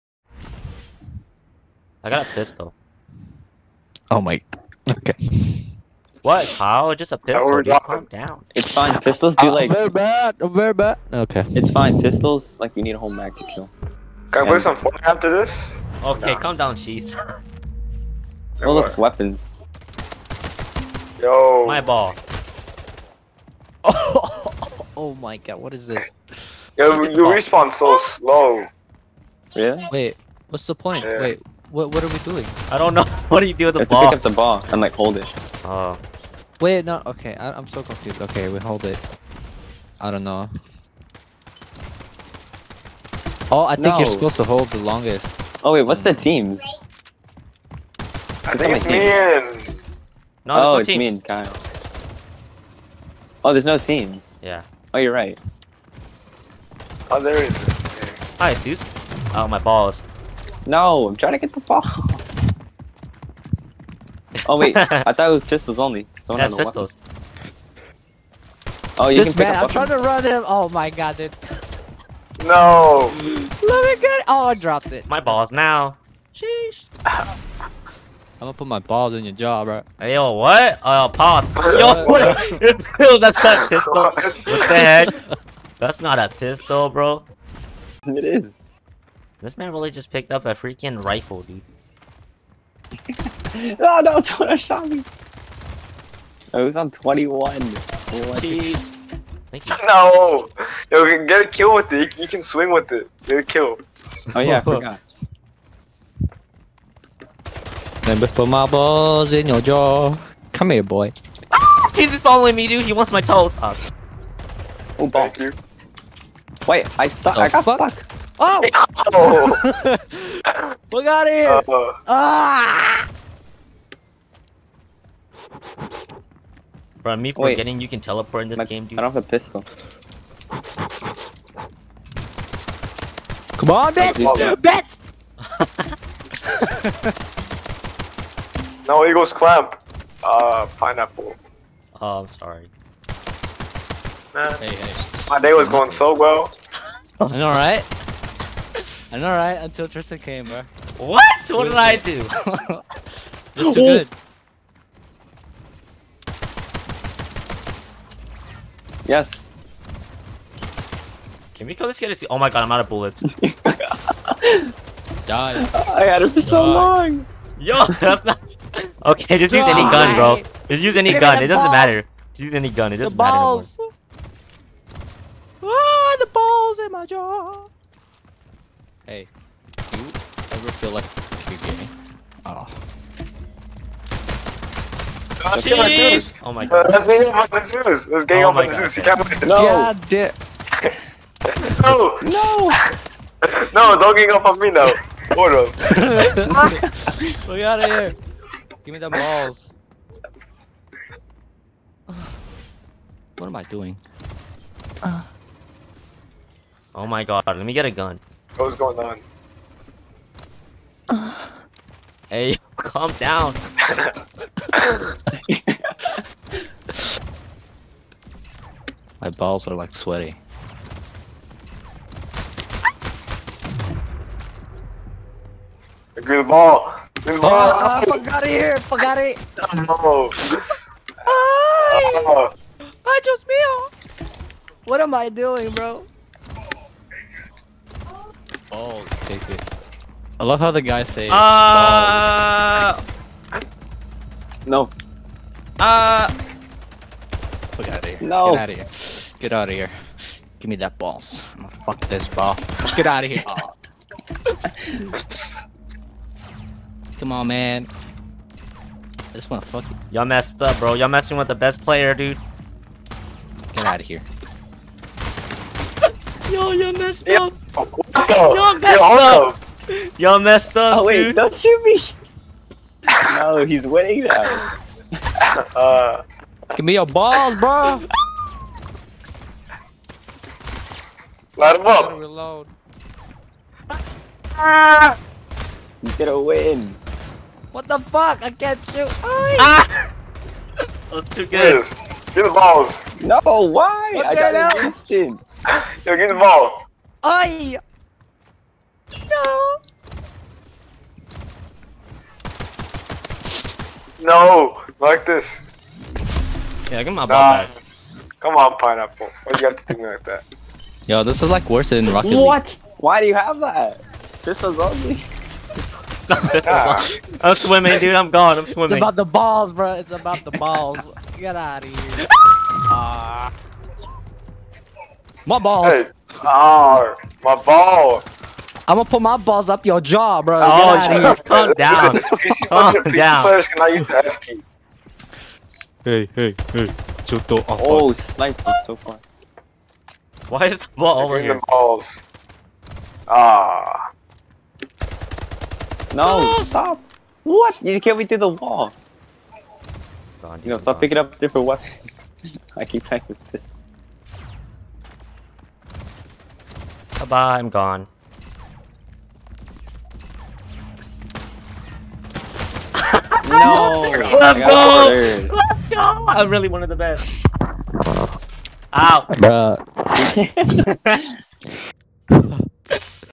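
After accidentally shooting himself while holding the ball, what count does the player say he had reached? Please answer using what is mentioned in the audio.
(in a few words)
21.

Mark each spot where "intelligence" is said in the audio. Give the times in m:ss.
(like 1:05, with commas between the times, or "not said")
not said.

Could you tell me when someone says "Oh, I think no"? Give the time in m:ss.
0:43.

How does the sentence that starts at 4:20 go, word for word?
Y'all messing with the best player, dude.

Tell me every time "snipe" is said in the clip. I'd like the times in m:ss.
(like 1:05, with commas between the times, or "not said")
5:38.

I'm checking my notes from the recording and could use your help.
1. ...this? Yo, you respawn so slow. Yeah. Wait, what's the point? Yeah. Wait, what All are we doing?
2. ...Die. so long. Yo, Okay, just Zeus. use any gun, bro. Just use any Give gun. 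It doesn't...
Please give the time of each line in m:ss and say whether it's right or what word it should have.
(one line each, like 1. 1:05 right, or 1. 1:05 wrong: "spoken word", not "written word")
1. 0:25 wrong: "What", not "All"
2. 2:46 wrong: "Die", not "Zeus".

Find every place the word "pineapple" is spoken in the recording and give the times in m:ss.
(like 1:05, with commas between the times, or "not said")
2:20, 5:08.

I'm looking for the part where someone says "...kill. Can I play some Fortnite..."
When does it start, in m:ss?
0:13.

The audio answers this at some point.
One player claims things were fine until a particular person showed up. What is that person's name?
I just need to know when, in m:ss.
2:29.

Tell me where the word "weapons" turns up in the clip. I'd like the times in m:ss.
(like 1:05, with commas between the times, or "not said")
0:18, 1:06, 5:51.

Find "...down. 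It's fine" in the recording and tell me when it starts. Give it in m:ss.
0:08.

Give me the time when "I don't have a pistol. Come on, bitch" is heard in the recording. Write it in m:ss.
2:08.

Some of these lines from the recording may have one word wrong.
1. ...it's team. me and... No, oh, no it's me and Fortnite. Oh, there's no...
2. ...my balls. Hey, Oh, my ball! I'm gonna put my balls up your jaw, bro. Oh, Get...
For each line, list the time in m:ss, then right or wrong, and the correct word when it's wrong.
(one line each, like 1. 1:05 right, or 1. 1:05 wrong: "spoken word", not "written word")
1. 0:48 wrong: "Kyle", not "Fortnite"
2. 5:25 right.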